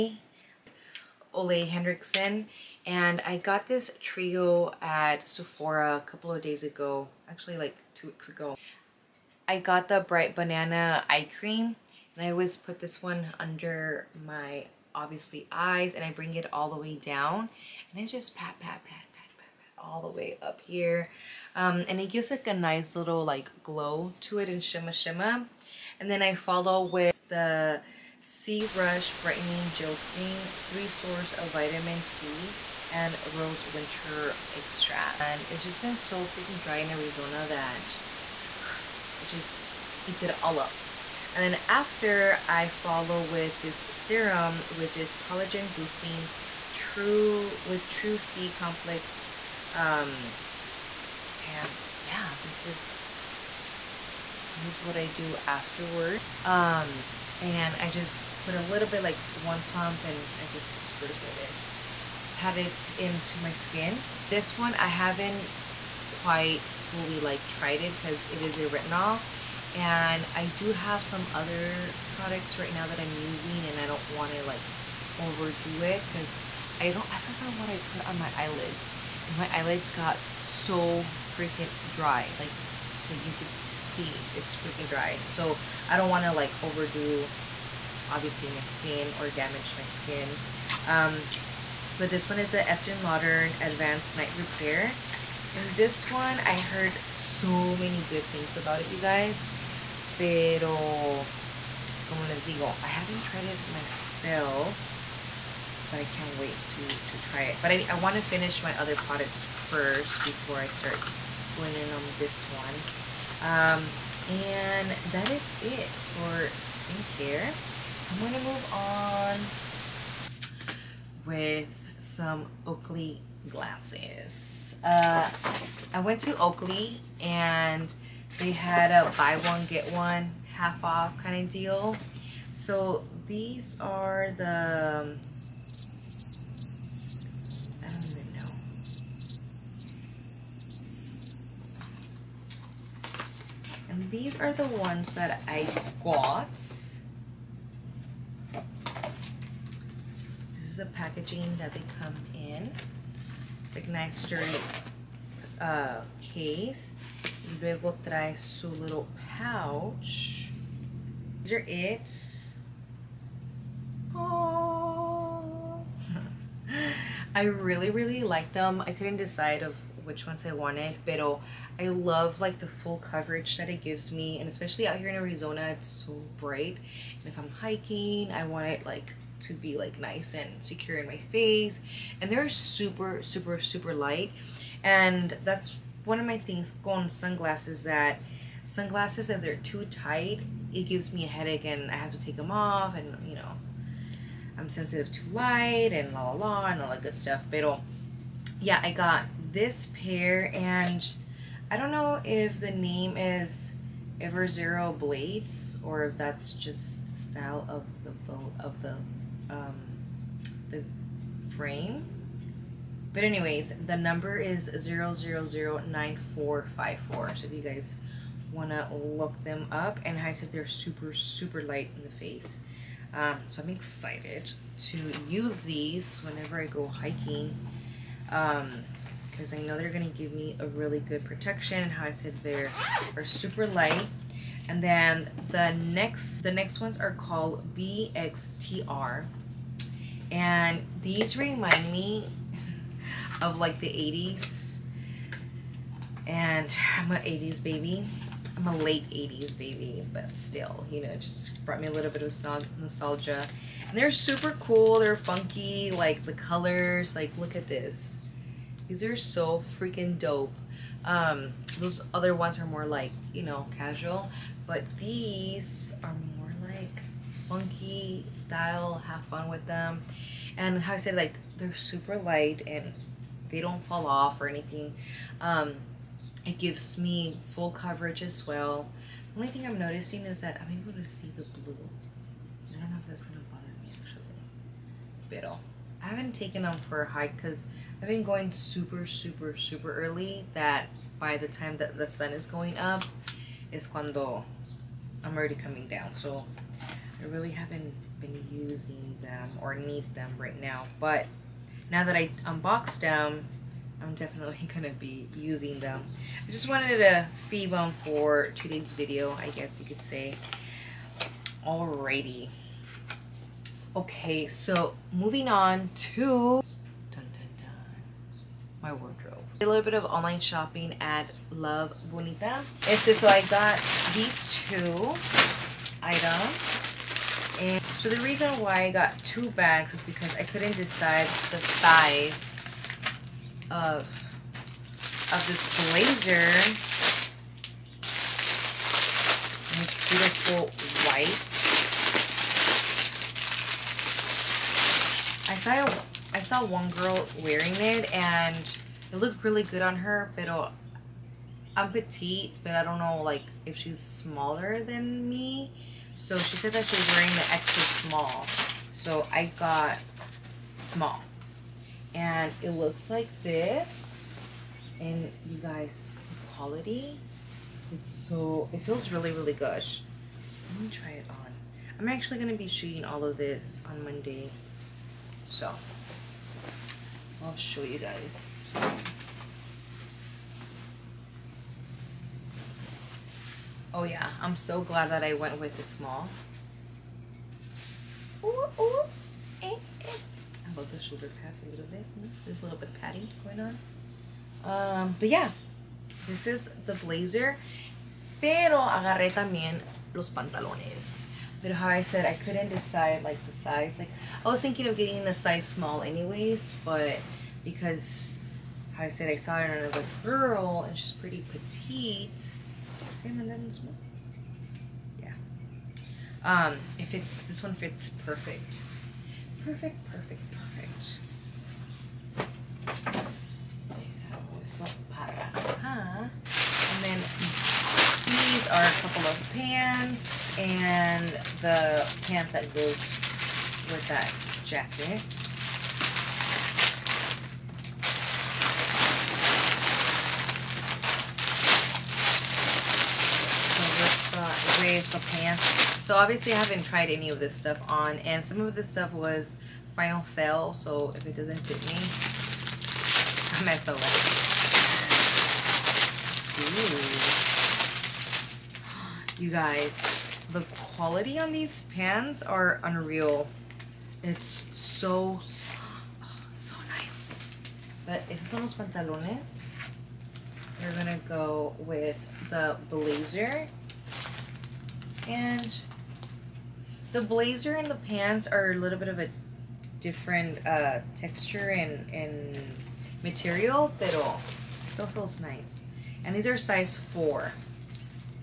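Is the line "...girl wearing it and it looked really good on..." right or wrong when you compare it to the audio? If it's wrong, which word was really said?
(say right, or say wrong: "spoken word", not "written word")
right.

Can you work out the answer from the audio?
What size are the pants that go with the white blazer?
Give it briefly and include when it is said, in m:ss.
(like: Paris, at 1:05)
Size 4, at 8:06.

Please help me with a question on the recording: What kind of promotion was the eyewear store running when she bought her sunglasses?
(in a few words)
Buy one get one half off.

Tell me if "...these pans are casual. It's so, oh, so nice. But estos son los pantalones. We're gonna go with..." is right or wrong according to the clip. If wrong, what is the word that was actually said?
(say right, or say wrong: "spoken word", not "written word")
wrong: "unreal", not "casual".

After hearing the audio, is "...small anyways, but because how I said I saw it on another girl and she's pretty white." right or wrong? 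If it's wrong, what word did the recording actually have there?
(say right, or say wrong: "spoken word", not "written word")
wrong: "petite", not "white".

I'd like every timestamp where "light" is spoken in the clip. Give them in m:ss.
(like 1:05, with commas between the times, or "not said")
3:03, 3:15, 3:41, 3:53, 4:32.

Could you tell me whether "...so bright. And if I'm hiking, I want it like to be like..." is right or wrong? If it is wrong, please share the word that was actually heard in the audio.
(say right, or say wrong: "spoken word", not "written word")
right.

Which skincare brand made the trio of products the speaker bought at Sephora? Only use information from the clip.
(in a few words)
Ole Henriksen.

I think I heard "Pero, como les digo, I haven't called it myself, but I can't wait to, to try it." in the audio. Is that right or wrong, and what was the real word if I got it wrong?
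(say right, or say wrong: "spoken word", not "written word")
wrong: "tried", not "called".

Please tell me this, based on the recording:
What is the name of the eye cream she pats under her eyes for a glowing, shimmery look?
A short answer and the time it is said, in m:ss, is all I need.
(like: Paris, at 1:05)
Bright banana eye cream, at 0:10.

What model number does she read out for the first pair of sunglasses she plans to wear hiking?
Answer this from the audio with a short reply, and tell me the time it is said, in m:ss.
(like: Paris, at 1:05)
0009454, at 3:34.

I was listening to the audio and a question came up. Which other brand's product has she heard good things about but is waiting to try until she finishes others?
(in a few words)
Estee Lauder Advanced Night Repair.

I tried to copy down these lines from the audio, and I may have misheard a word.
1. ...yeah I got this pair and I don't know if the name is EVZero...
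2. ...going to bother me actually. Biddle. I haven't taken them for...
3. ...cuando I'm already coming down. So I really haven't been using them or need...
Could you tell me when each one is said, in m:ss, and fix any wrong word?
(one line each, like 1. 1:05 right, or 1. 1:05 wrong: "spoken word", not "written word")
1. 3:18 right
2. 4:43 right
3. 4:53 right.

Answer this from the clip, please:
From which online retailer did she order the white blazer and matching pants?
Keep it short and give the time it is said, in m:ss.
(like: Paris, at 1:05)
Love Bonito, at 5:21.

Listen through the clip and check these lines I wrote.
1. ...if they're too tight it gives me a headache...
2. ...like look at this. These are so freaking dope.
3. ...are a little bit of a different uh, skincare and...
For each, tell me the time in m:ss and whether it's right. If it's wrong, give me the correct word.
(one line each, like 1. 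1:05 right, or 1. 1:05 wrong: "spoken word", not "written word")
1. 3:09 right
2. 4:17 right
3. 7:58 wrong: "texture", not "skincare".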